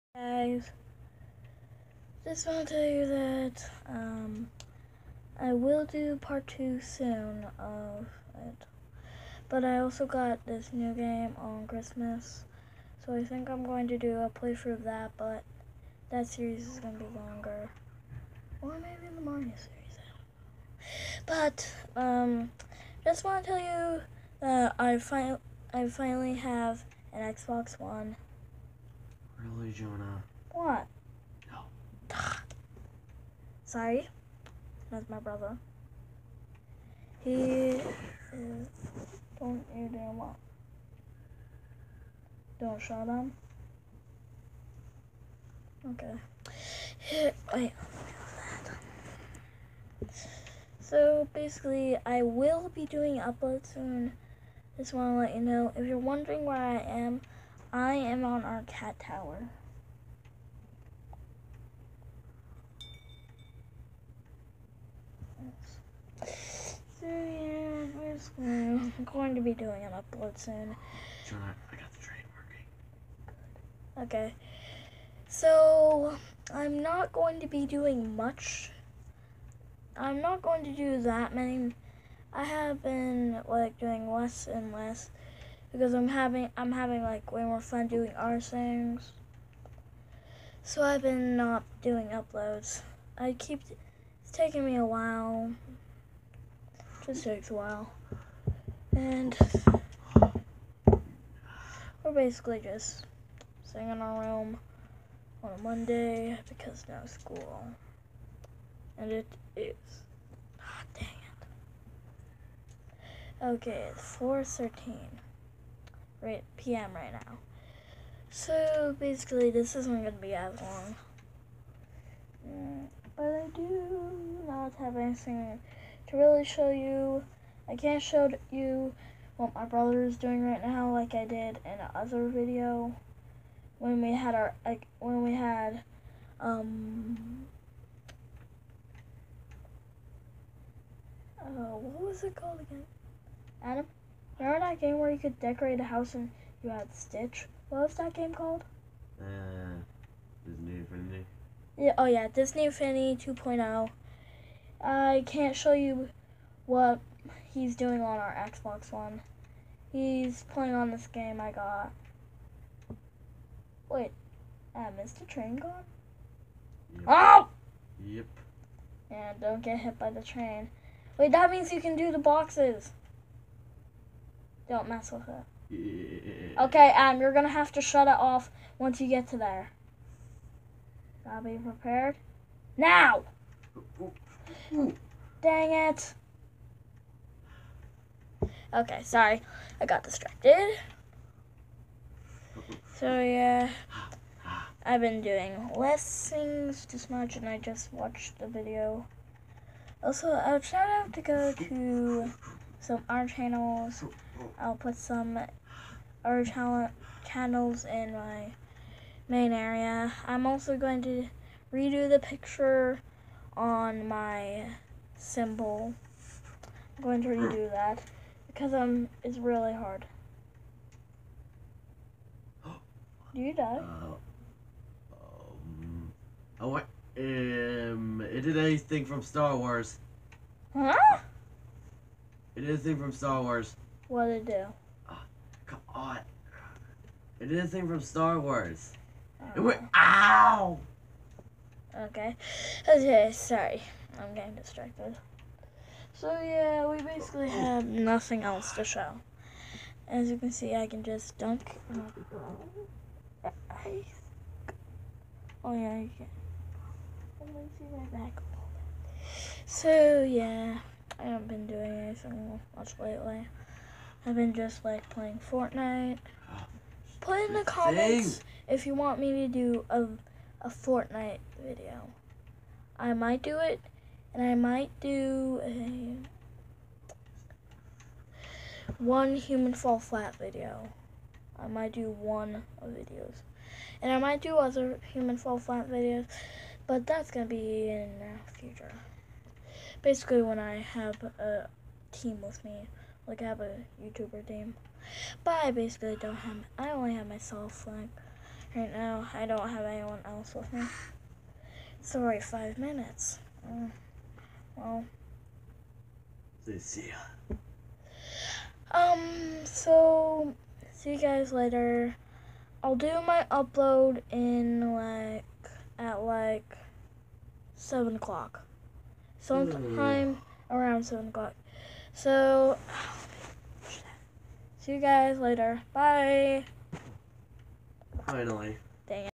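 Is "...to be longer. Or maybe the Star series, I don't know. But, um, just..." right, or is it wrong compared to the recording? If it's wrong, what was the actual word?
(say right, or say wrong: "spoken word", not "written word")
wrong: "Mario", not "Star".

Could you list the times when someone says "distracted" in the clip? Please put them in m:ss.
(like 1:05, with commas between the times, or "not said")
3:10, 4:04.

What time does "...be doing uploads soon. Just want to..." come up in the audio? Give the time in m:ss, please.
0:52.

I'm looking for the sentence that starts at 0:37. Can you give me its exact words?
He is don't you do what?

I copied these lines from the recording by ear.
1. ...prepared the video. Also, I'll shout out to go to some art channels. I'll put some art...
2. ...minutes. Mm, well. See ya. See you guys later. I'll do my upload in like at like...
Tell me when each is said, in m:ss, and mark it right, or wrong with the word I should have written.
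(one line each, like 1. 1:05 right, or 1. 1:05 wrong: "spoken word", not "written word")
1. 3:17 wrong: "watched", not "prepared"
2. 5:02 right.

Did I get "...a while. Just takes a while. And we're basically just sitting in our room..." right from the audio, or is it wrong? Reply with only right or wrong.
right.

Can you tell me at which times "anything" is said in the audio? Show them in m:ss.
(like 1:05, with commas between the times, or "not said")
2:04, 3:48, 3:52, 3:57, 4:21.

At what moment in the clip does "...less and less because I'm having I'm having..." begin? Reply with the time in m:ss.
1:24.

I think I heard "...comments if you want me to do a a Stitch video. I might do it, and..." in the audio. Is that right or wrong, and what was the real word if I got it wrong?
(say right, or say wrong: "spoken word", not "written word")
wrong: "Fortnite", not "Stitch".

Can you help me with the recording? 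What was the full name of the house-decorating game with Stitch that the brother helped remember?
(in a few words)
Disney Infinity 2.0.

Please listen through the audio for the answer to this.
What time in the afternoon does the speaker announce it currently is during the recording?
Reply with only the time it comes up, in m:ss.
1:54.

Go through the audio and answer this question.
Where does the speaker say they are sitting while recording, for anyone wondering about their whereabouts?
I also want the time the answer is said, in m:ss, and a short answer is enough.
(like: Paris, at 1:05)
cat tower, at 0:58.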